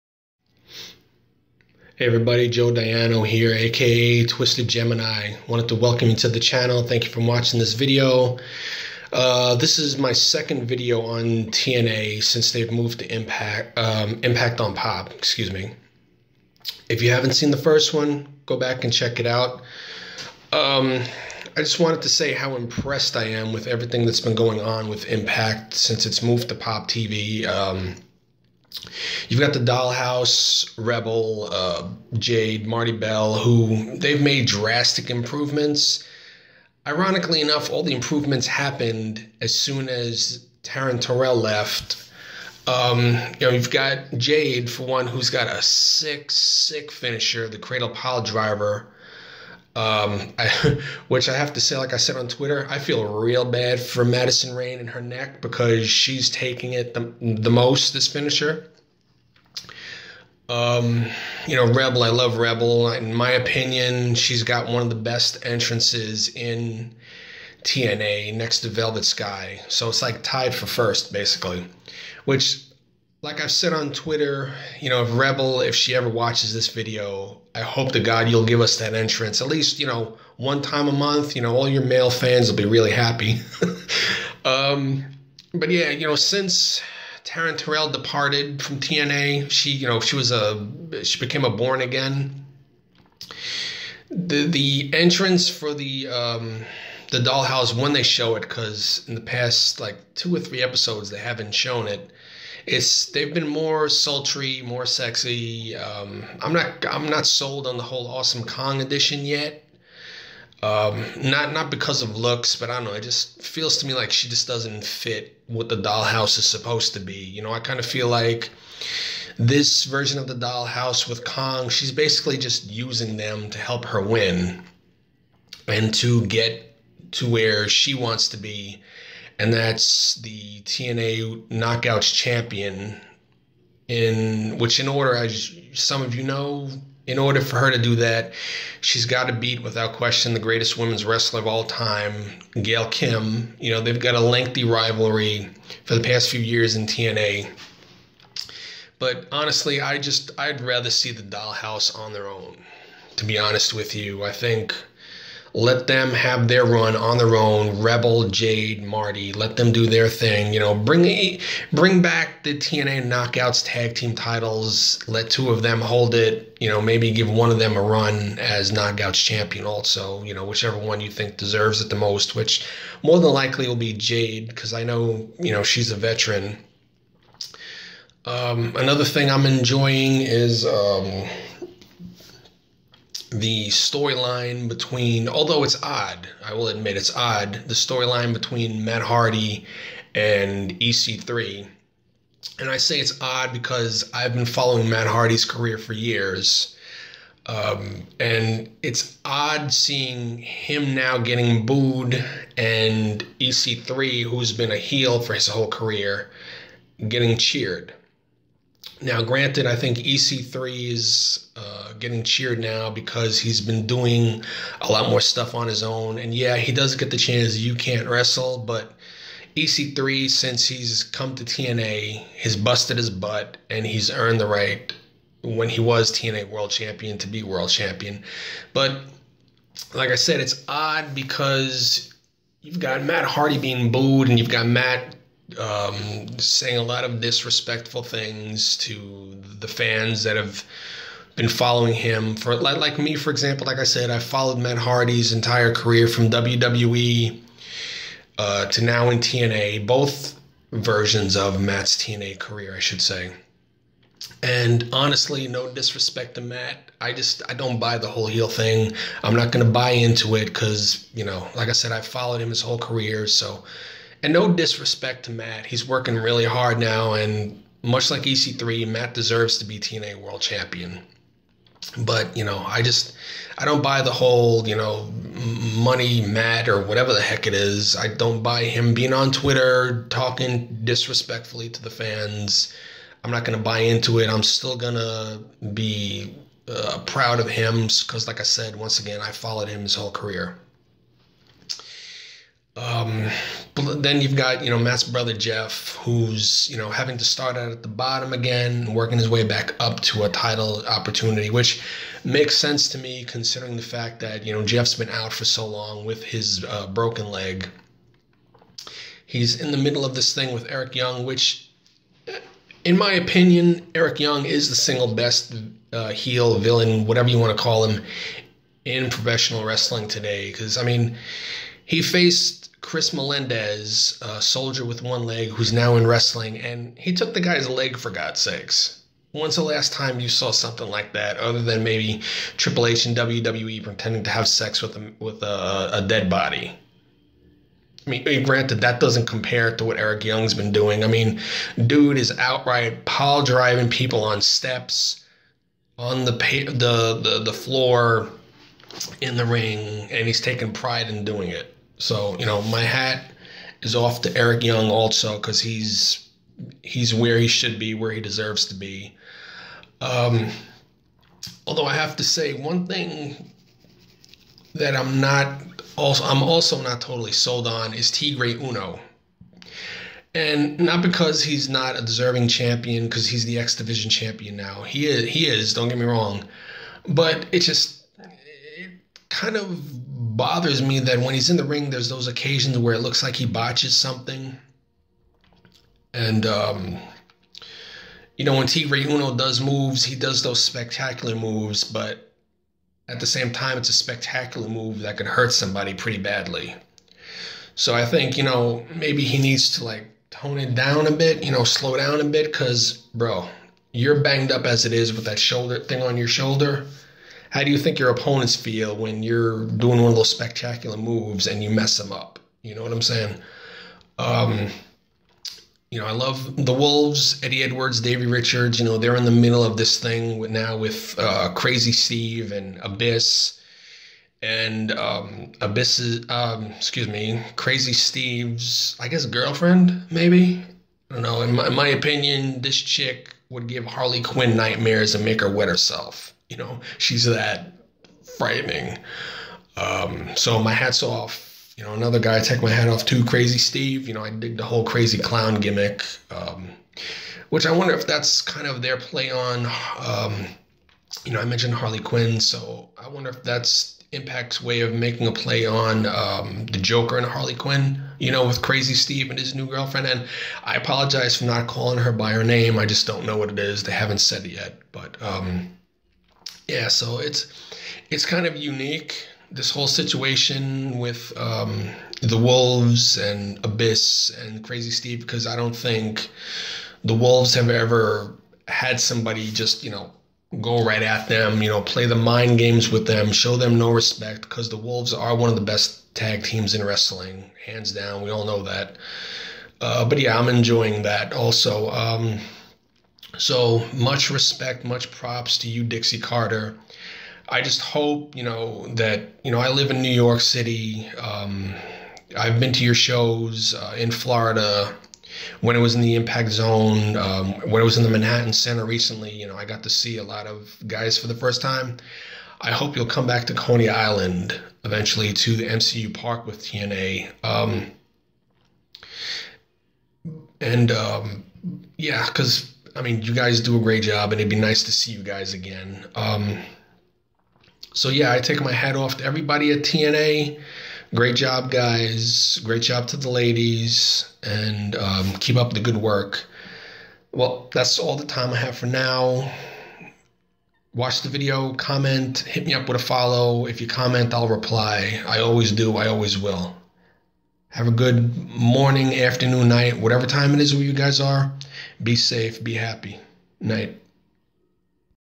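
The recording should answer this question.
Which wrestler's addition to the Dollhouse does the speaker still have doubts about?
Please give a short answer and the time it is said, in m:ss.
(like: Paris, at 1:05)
Awesome Kong, at 1:48.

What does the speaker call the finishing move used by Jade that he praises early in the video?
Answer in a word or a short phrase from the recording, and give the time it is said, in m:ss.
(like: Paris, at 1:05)
Cradle Pile Driver, at 0:47.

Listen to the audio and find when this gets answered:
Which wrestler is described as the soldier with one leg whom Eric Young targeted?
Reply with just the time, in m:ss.
5:22.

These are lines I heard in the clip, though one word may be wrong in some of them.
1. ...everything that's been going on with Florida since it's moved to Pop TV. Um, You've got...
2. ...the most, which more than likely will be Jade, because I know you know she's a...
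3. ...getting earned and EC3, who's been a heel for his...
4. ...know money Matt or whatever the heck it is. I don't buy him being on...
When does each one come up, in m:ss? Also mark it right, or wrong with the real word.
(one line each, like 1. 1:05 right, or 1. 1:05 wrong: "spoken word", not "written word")
1. 0:23 wrong: "Impact", not "Florida"
2. 2:51 right
3. 3:21 wrong: "booed", not "earned"
4. 4:34 right.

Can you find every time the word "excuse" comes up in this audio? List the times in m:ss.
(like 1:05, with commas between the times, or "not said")
0:15, 7:06.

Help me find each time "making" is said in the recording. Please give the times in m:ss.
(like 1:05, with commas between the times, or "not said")
7:34.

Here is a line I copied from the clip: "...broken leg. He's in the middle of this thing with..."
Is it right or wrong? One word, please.
right.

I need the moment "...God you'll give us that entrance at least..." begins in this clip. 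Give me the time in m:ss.
1:17.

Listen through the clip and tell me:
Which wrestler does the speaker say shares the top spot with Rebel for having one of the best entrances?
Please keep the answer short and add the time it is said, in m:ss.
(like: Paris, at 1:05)
Velvet Sky, at 1:08.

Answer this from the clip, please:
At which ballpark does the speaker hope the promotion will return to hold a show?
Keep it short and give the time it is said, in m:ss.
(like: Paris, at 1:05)
MCU Park, at 8:35.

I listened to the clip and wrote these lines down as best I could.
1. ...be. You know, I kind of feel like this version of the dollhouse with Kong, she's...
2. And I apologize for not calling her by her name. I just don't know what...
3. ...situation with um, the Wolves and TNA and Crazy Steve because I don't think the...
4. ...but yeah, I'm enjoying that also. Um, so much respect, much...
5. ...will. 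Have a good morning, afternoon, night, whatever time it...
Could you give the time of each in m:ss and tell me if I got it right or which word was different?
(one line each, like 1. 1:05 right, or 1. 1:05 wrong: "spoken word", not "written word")
1. 1:56 right
2. 7:40 right
3. 7:49 wrong: "Abyss", not "TNA"
4. 8:10 right
5. 9:06 right.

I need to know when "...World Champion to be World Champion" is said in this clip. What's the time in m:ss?
3:46.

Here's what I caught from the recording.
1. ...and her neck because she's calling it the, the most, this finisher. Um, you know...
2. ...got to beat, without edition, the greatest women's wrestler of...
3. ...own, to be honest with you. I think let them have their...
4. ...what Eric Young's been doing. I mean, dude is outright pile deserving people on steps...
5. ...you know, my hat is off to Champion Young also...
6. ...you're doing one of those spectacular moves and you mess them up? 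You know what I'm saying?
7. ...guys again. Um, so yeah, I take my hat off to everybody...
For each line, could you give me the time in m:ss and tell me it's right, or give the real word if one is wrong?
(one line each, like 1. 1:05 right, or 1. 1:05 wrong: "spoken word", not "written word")
1. 0:54 wrong: "taking", not "calling"
2. 2:19 wrong: "question", not "edition"
3. 2:32 right
4. 5:39 wrong: "driving", not "deserving"
5. 5:52 wrong: "Eric", not "Champion"
6. 6:49 right
7. 8:45 right.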